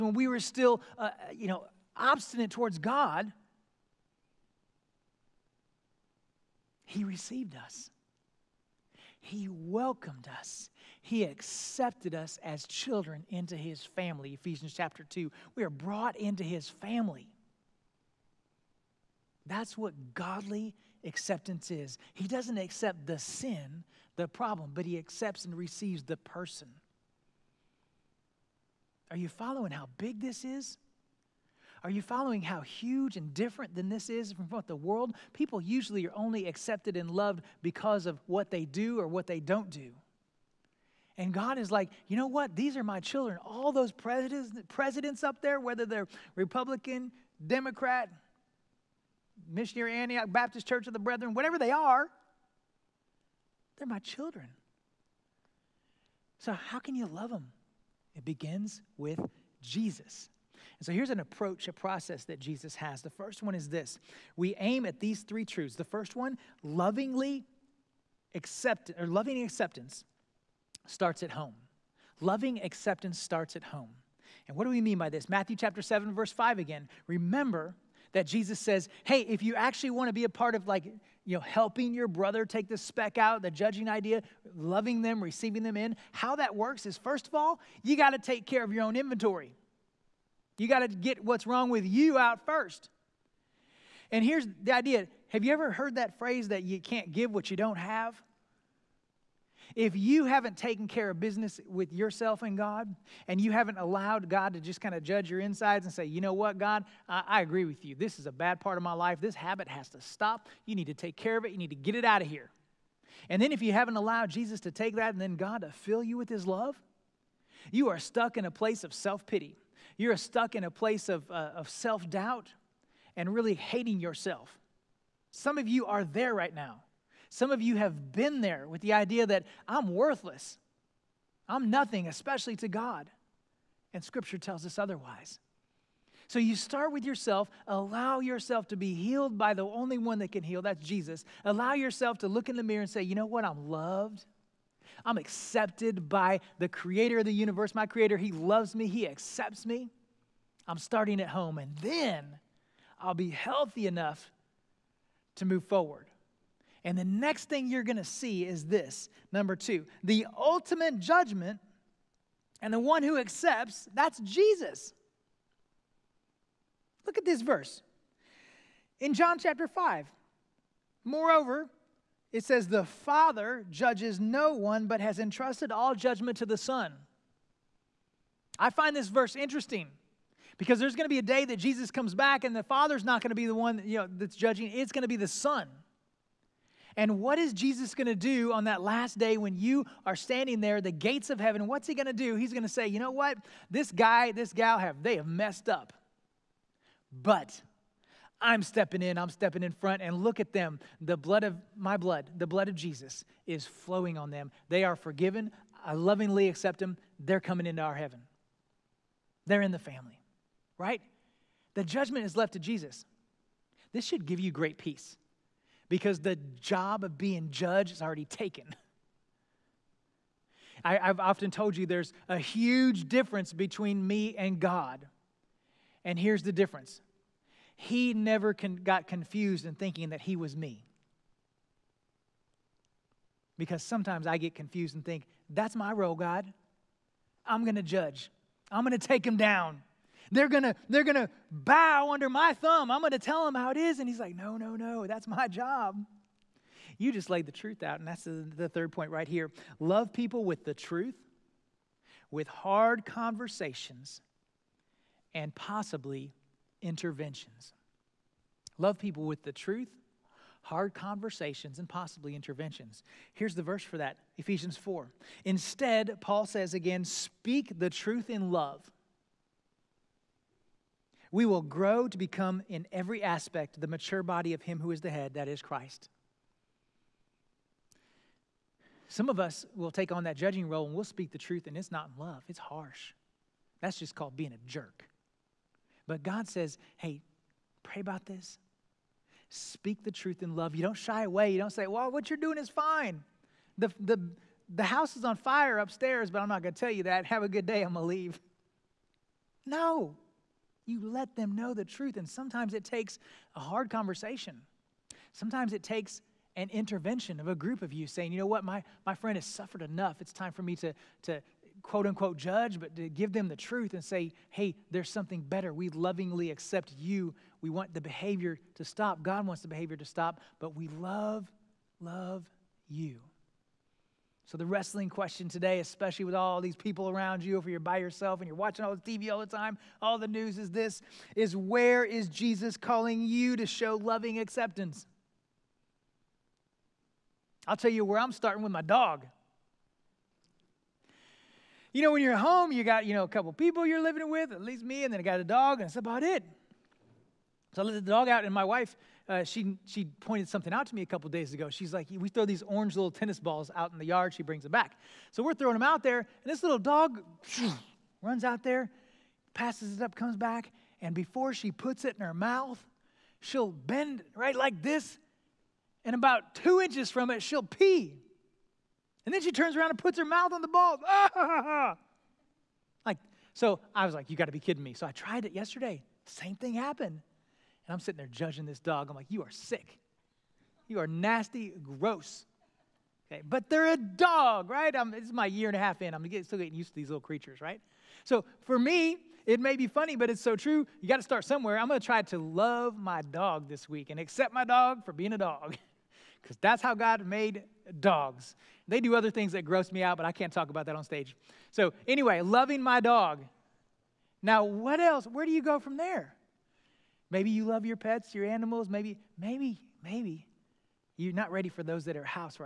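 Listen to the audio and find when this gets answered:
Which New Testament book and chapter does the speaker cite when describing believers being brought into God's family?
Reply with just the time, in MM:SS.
00:14.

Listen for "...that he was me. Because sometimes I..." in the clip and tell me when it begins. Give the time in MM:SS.
03:50.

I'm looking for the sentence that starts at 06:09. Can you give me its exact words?
And then she turns around and puts her mouth on the ball.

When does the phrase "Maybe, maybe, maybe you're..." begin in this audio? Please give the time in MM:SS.
06:48.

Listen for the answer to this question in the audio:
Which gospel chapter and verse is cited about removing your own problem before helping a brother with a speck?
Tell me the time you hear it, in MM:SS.
01:15.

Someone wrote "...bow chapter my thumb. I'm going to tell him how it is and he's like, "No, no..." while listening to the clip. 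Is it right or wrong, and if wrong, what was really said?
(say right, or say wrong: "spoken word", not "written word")
wrong: "under", not "chapter".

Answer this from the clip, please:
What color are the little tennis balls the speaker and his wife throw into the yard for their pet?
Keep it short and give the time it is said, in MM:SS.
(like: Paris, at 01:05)
Orange, at 05:52.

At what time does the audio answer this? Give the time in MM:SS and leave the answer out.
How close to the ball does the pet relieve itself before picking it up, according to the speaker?
06:06.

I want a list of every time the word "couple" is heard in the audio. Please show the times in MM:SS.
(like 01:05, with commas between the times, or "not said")
05:43, 05:51.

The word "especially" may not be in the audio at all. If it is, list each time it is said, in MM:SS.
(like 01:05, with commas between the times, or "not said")
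02:12, 05:25.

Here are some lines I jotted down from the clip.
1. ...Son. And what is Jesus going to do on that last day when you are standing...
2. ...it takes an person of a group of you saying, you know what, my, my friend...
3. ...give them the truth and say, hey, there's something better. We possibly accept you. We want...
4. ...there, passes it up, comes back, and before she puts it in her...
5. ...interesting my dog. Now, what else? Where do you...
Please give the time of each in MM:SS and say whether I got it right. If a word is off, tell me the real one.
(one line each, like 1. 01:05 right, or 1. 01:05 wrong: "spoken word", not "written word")
1. 03:05 right
2. 05:05 wrong: "intervention", not "person"
3. 05:13 wrong: "lovingly", not "possibly"
4. 05:58 right
5. 06:42 wrong: "loving", not "interesting".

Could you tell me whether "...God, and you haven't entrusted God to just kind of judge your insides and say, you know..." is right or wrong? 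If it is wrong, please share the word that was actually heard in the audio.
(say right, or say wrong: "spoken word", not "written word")
wrong: "allowed", not "entrusted".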